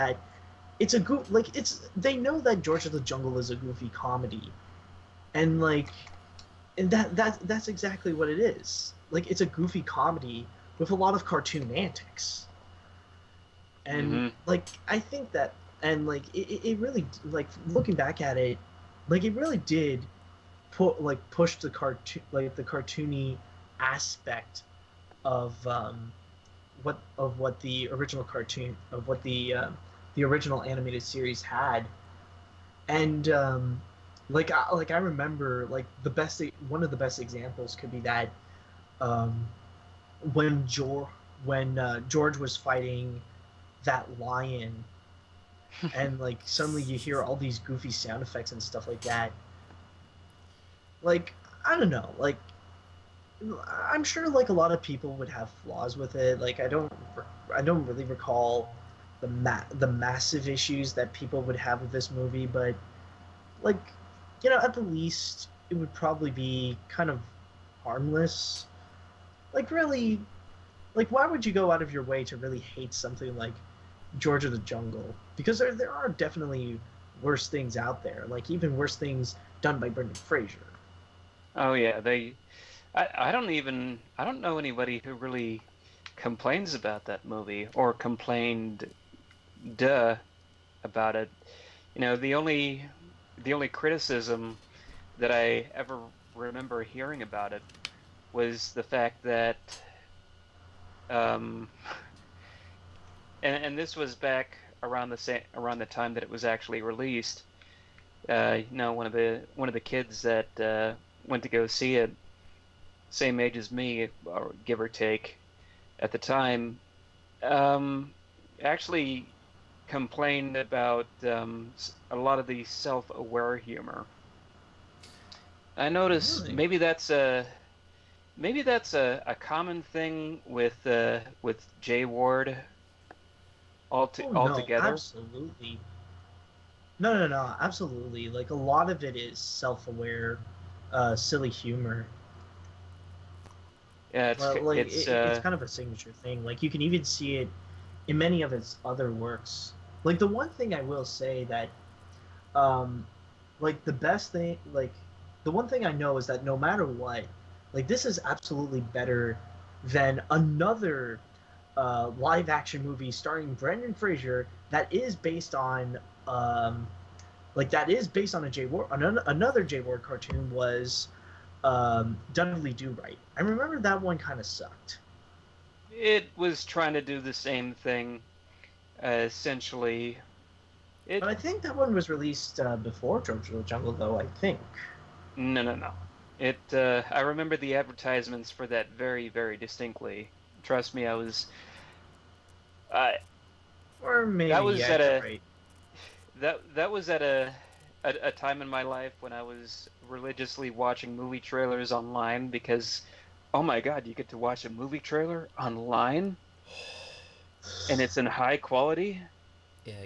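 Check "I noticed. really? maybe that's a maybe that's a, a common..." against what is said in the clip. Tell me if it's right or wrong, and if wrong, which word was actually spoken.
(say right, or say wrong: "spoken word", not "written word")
right.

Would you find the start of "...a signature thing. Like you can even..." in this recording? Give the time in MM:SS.
02:25.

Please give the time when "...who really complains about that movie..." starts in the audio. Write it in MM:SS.
01:25.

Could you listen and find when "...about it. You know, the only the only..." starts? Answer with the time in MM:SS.
01:30.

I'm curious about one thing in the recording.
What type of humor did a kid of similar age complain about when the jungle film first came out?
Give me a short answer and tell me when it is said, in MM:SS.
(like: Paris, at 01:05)
self-aware humor, at 02:02.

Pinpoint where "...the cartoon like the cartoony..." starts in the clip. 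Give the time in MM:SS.
00:21.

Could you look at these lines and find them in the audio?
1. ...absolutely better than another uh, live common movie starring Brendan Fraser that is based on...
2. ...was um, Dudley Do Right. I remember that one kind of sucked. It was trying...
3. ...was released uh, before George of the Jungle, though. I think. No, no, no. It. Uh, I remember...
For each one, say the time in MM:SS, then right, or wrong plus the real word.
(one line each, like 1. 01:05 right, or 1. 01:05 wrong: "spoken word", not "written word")
1. 02:38 wrong: "action", not "common"
2. 02:50 right
3. 03:01 right.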